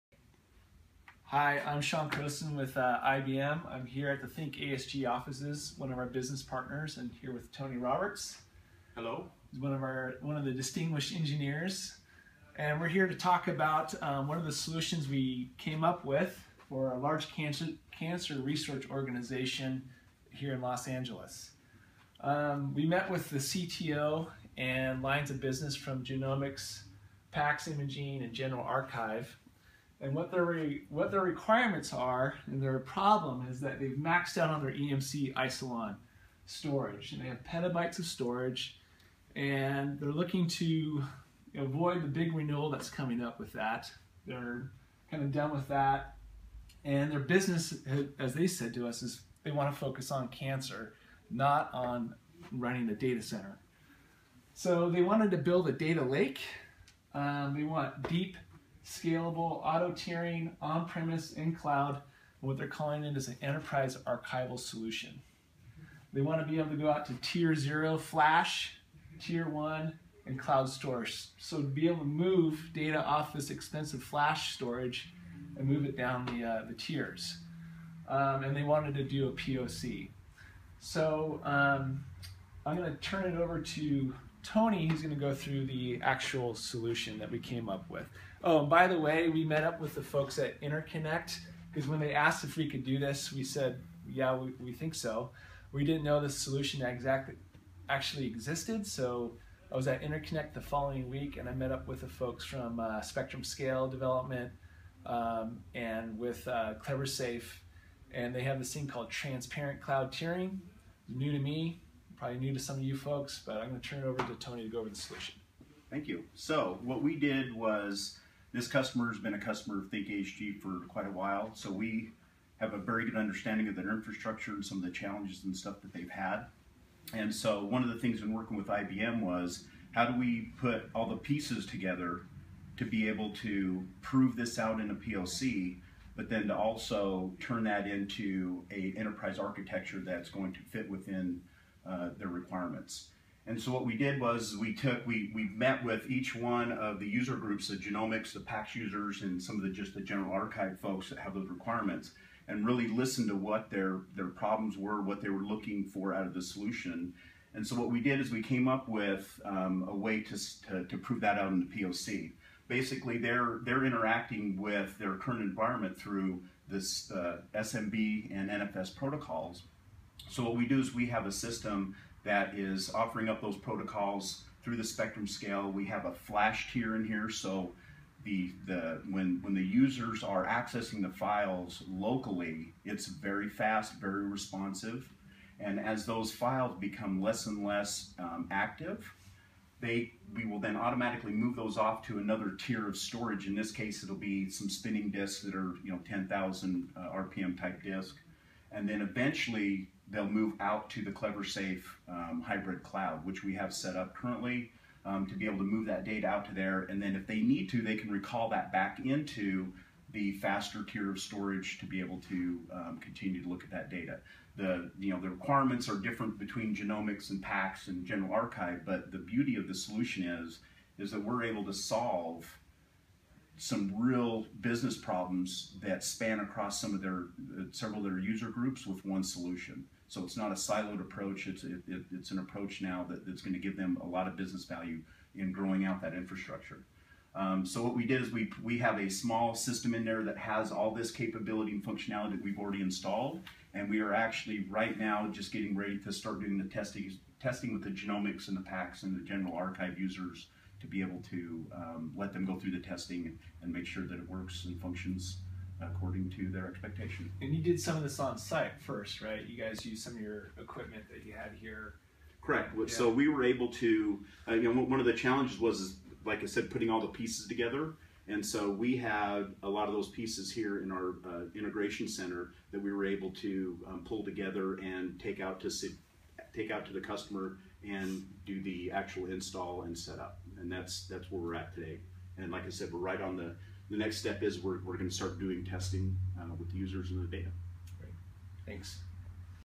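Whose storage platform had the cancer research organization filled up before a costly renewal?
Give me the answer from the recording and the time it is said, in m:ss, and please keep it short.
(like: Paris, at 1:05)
EMC Isilon, at 0:34.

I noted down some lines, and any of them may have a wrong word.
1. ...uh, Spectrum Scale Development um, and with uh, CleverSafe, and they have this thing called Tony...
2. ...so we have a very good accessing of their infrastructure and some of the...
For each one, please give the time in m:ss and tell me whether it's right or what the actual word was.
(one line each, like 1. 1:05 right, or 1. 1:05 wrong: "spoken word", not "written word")
1. 1:42 wrong: "Transparent", not "Tony"
2. 2:01 wrong: "understanding", not "accessing".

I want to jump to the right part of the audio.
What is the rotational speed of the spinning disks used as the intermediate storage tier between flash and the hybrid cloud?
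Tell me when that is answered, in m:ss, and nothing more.
3:16.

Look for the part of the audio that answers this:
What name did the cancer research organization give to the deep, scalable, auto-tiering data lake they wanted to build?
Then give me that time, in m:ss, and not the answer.
1:03.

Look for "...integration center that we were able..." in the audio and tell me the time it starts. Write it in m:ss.
4:31.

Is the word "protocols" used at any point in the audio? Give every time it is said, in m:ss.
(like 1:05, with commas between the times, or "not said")
2:48, 2:53.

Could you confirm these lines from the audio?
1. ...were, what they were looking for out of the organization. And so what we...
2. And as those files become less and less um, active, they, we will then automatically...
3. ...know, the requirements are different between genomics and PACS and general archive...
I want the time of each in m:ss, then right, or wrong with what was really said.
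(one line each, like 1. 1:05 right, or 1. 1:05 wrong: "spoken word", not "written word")
1. 2:34 wrong: "solution", not "organization"
2. 3:05 right
3. 3:35 right.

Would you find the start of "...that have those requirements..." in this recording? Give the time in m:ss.
2:31.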